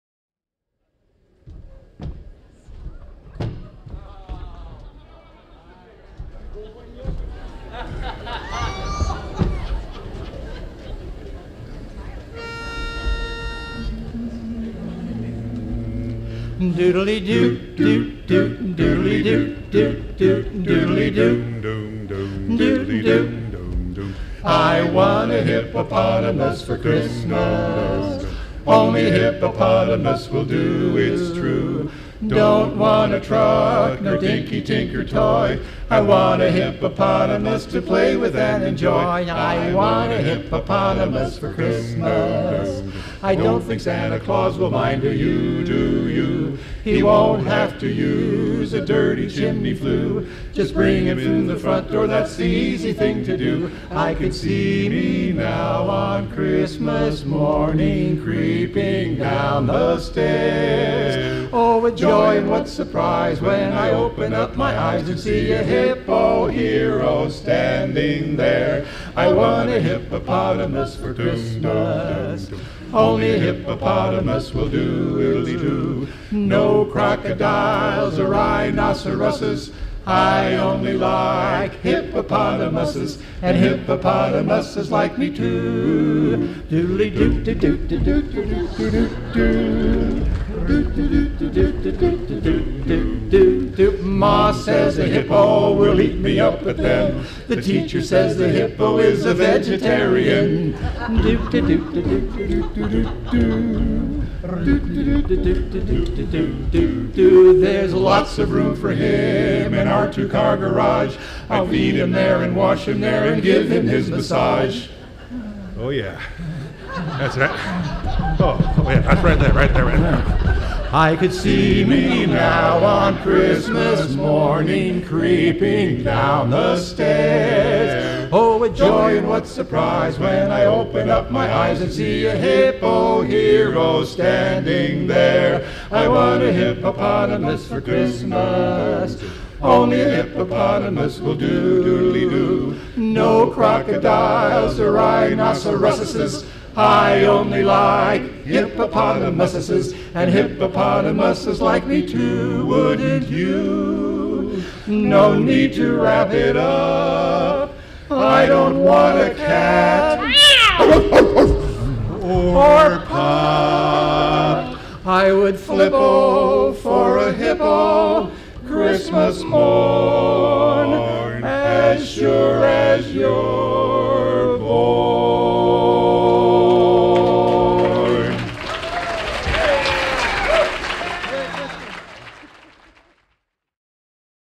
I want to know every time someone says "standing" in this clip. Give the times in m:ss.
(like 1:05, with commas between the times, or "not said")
1:07, 2:14.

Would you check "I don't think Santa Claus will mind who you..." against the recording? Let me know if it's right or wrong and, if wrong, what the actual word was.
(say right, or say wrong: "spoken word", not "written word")
right.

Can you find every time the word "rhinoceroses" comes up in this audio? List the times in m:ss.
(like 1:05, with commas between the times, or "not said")
1:18, 2:24.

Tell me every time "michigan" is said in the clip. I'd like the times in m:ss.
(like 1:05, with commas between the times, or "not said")
not said.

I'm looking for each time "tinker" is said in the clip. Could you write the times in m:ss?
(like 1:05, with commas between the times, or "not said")
0:34.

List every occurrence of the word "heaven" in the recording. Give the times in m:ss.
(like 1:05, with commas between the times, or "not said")
not said.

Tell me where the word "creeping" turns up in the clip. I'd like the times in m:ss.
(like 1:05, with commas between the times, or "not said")
0:58, 2:05.